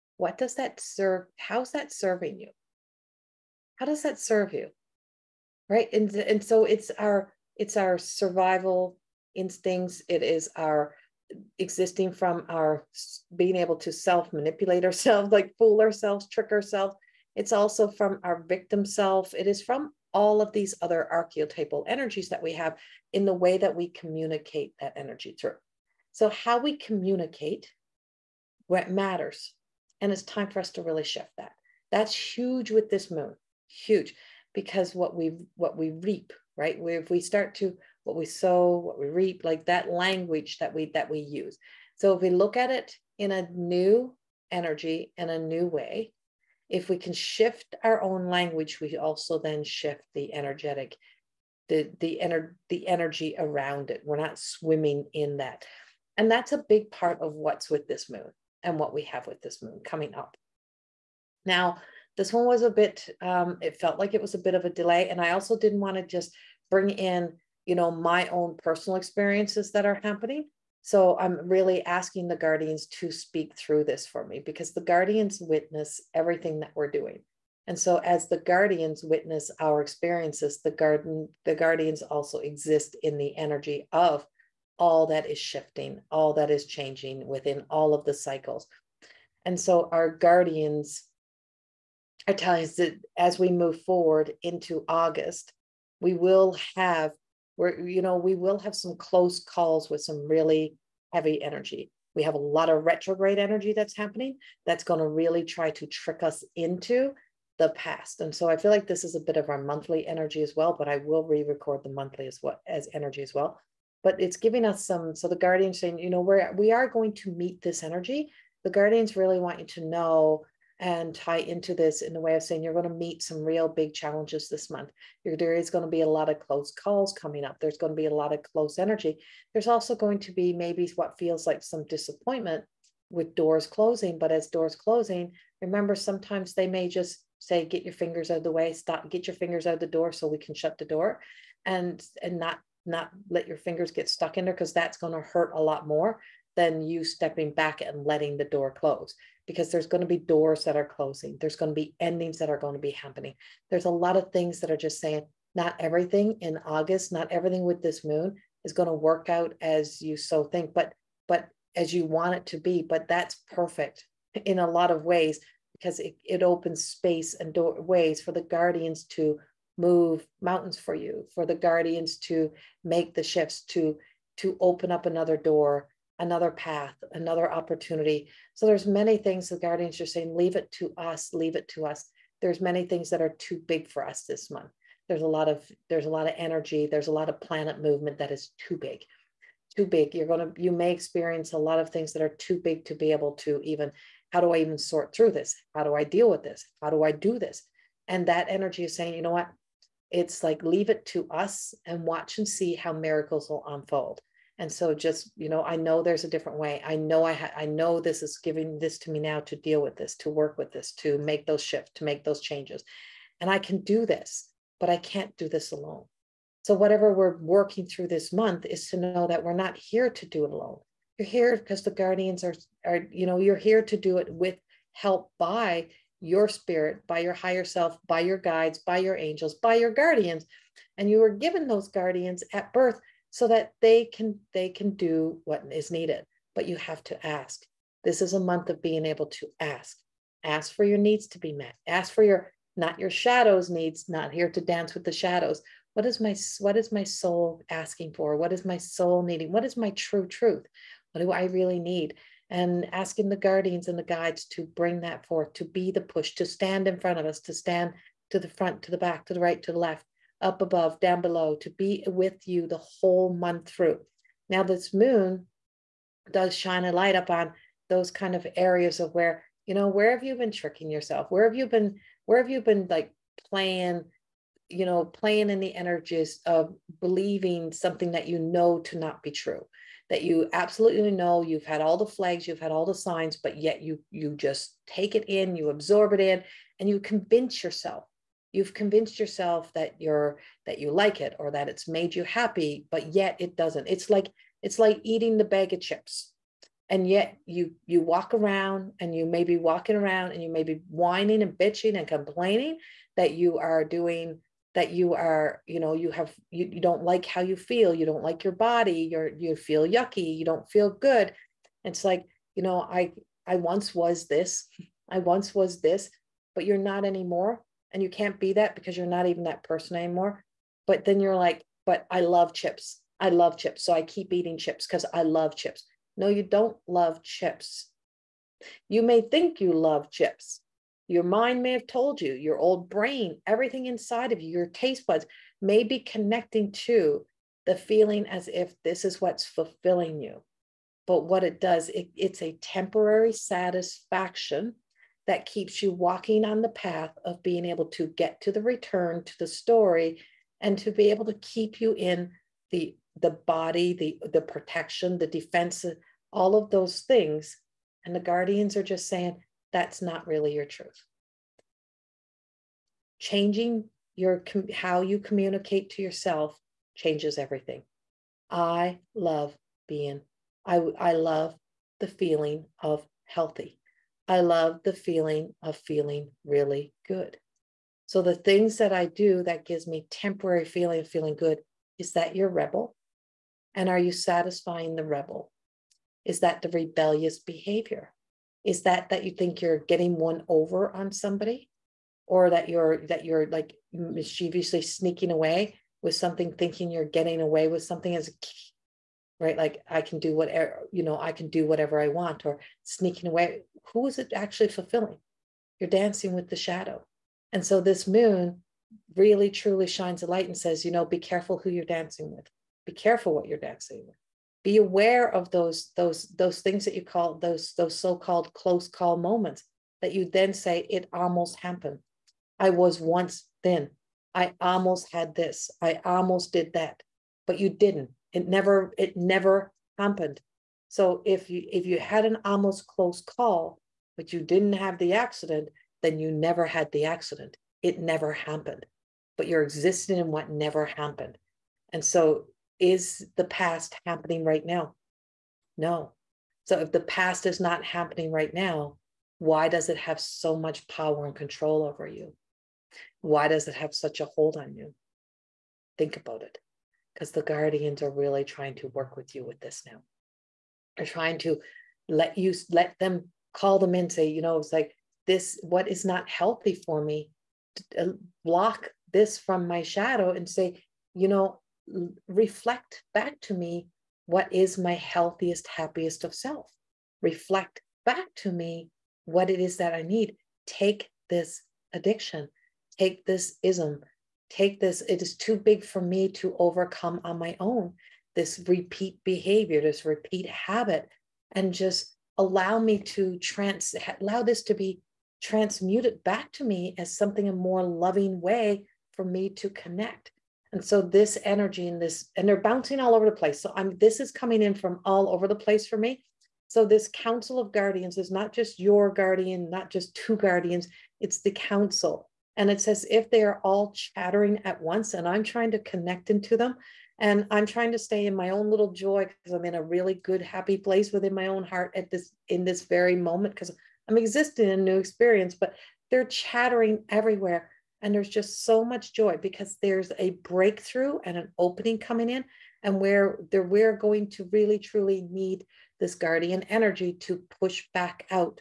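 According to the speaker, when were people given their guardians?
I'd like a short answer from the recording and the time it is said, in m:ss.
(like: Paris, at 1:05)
at birth, at 3:52.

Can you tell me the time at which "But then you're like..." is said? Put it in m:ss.
5:20.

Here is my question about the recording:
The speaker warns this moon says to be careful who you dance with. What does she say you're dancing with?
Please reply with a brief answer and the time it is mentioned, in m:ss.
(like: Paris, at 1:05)
the shadow, at 6:46.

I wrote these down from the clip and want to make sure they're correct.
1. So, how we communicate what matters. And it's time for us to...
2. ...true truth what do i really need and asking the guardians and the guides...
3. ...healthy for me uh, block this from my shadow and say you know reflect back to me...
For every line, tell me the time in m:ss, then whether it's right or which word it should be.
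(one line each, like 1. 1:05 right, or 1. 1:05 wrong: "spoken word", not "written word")
1. 0:26 right
2. 4:09 right
3. 7:46 right.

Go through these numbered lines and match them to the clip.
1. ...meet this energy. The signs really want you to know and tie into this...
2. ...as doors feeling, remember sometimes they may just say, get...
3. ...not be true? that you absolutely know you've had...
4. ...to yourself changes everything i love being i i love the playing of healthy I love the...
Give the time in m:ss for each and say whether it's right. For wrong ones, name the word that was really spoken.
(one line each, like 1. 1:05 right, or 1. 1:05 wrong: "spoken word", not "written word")
1. 1:57 wrong: "guardians", not "signs"
2. 2:14 wrong: "closing", not "feeling"
3. 4:38 right
4. 6:05 wrong: "feeling", not "playing".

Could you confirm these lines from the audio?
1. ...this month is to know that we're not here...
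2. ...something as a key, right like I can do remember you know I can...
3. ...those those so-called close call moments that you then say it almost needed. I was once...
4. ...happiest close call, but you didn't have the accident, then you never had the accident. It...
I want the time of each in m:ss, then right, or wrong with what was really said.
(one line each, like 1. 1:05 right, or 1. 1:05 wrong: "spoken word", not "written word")
1. 3:38 right
2. 6:37 wrong: "whatever", not "remember"
3. 6:57 wrong: "happened", not "needed"
4. 7:12 wrong: "almost", not "happiest".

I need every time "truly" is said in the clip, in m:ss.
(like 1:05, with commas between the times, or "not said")
6:49, 8:54.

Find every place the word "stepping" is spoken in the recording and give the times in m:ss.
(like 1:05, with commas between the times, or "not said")
2:27.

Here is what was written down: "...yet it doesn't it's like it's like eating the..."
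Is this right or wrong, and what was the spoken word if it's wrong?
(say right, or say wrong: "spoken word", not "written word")
right.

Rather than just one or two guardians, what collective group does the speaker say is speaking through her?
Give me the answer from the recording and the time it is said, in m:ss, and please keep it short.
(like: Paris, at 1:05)
council of guardians, at 8:27.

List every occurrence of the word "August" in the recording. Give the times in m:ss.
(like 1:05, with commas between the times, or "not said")
1:34, 2:36.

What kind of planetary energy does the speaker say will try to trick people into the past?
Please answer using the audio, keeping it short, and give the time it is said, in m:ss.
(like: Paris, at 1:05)
retrograde energy, at 1:42.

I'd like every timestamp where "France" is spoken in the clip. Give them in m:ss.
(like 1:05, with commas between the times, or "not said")
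not said.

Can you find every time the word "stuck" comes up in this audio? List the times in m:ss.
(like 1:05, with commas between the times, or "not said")
2:24.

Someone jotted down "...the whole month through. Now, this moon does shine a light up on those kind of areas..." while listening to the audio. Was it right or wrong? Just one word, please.
right.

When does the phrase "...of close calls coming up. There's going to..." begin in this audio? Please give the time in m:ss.
2:06.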